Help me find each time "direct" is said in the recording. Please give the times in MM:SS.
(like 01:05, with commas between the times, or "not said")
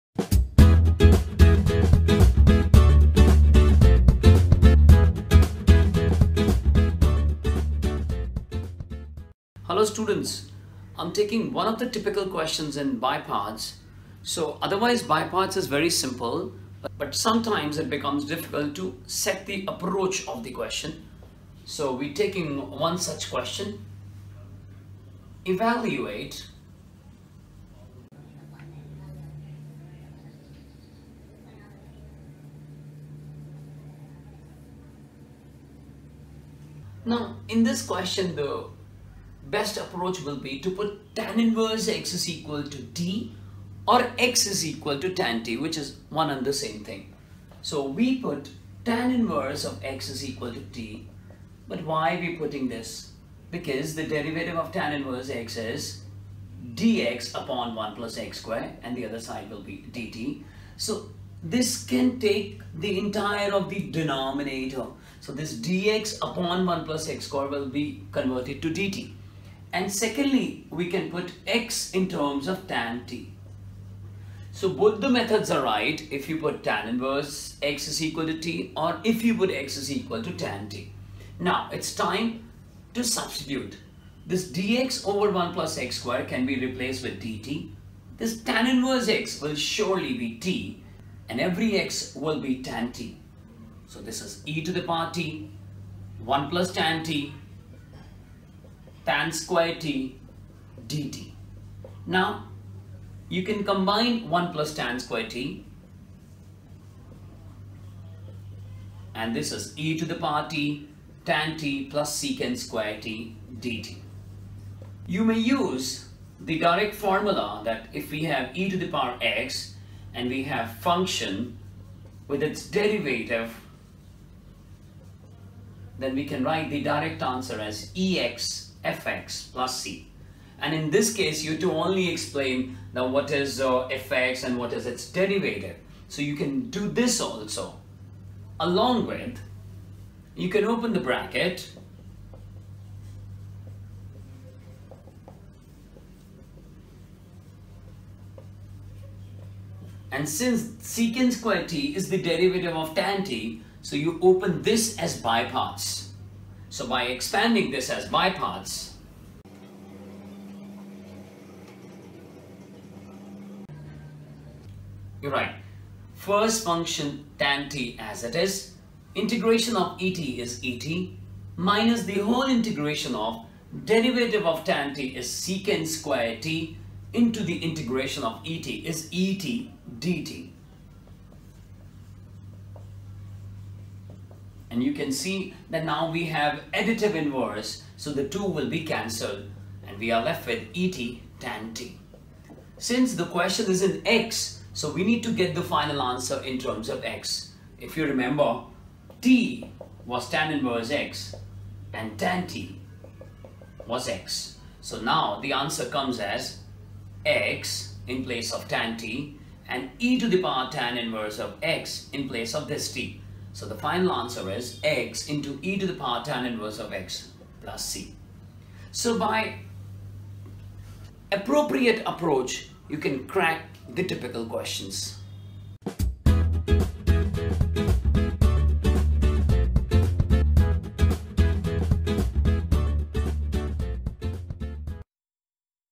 01:56, 02:06.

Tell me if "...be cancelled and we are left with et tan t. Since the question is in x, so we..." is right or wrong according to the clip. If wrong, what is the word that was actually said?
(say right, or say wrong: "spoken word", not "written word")
right.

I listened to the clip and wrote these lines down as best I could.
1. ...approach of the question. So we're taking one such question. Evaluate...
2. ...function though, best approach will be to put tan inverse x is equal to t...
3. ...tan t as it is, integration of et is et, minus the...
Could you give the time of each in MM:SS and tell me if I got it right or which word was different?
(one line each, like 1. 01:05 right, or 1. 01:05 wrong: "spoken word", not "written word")
1. 00:19 right
2. 00:37 wrong: "question", not "function"
3. 02:47 right.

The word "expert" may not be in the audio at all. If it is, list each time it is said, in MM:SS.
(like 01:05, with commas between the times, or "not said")
not said.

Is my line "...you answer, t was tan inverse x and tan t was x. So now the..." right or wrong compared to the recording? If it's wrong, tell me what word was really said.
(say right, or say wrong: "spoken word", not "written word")
wrong: "remember", not "answer".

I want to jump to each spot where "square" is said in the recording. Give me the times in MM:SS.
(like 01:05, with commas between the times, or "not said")
00:58, 01:07, 01:25, 01:39, 01:44, 01:52, 02:31, 02:55.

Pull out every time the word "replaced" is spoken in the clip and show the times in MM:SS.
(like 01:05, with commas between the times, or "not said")
01:26.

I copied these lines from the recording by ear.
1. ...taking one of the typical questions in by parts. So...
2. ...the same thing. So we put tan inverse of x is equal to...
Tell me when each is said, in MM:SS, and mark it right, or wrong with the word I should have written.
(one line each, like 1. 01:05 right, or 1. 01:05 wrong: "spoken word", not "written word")
1. 00:11 right
2. 00:46 right.